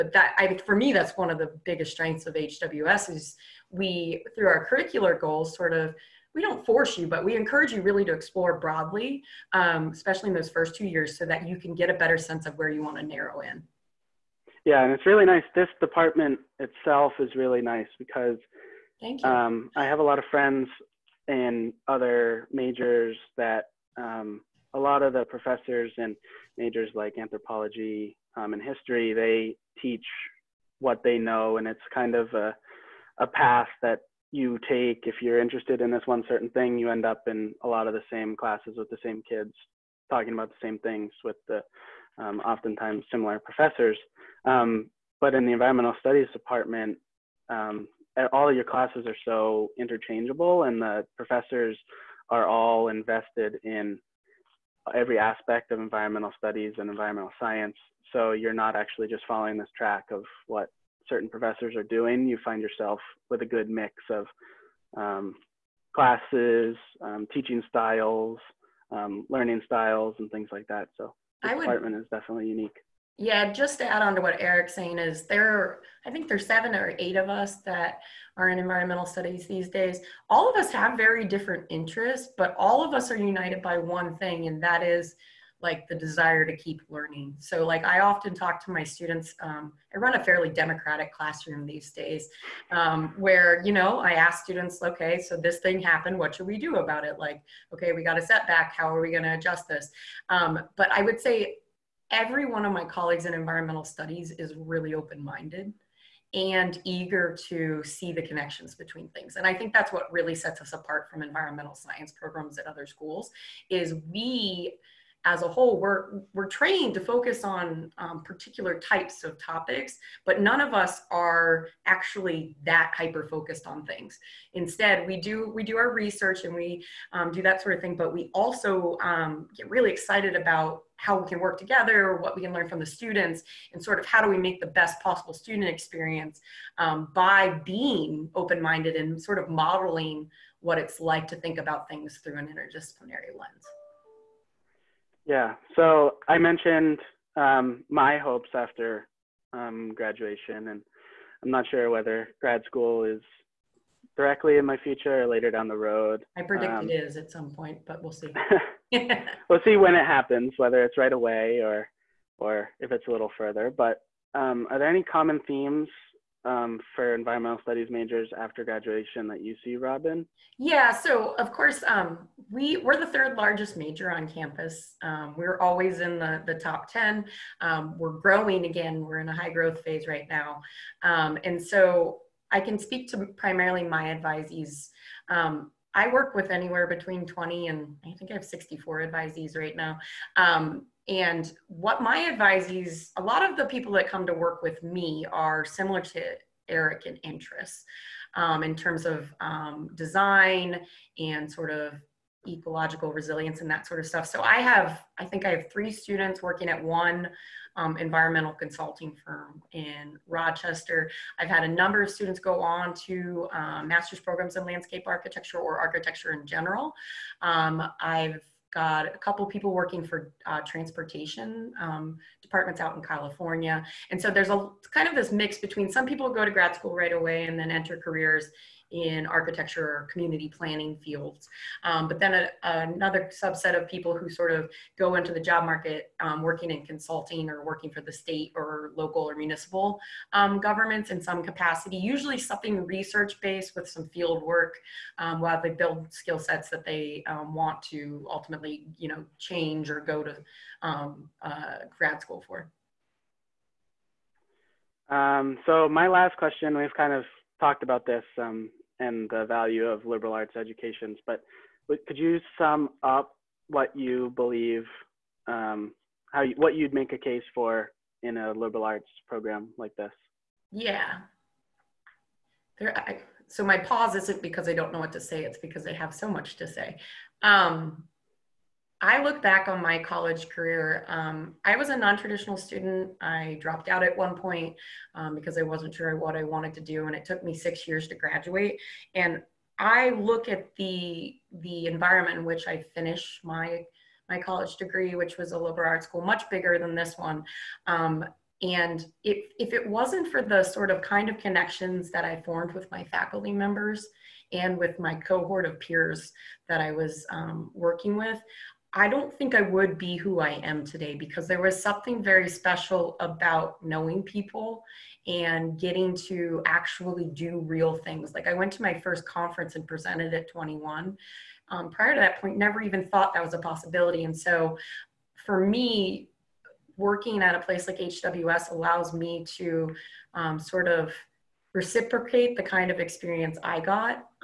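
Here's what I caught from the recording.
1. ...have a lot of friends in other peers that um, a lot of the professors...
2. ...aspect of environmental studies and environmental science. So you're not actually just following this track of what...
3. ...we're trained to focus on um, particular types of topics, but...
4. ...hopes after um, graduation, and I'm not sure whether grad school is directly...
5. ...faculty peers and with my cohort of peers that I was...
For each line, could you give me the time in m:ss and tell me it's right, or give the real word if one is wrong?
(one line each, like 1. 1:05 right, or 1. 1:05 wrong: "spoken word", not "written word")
1. 0:19 wrong: "majors", not "peers"
2. 0:55 right
3. 1:56 right
4. 2:28 right
5. 5:03 wrong: "members", not "peers".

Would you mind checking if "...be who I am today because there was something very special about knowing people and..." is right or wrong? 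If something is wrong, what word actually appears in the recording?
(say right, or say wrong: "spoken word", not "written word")
right.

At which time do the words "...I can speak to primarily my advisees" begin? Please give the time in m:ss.
3:02.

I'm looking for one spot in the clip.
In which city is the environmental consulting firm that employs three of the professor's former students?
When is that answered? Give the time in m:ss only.
3:30.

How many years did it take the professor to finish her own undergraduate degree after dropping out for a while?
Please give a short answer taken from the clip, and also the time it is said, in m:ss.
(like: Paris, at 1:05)
6, at 4:47.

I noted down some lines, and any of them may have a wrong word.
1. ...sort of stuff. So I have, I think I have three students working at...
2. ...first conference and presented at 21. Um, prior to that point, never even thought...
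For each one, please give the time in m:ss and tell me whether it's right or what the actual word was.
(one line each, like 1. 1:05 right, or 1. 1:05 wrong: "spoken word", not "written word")
1. 3:23 right
2. 5:19 right.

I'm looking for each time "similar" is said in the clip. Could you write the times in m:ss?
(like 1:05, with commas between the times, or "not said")
0:43, 3:15.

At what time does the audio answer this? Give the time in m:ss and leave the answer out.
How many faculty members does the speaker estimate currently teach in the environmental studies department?
1:16.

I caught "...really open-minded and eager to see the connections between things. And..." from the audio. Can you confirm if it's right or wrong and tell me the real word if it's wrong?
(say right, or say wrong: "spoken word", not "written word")
right.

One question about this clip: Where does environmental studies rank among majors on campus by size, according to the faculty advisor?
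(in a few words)
third largest.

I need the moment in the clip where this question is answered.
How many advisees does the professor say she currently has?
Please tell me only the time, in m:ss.
3:08.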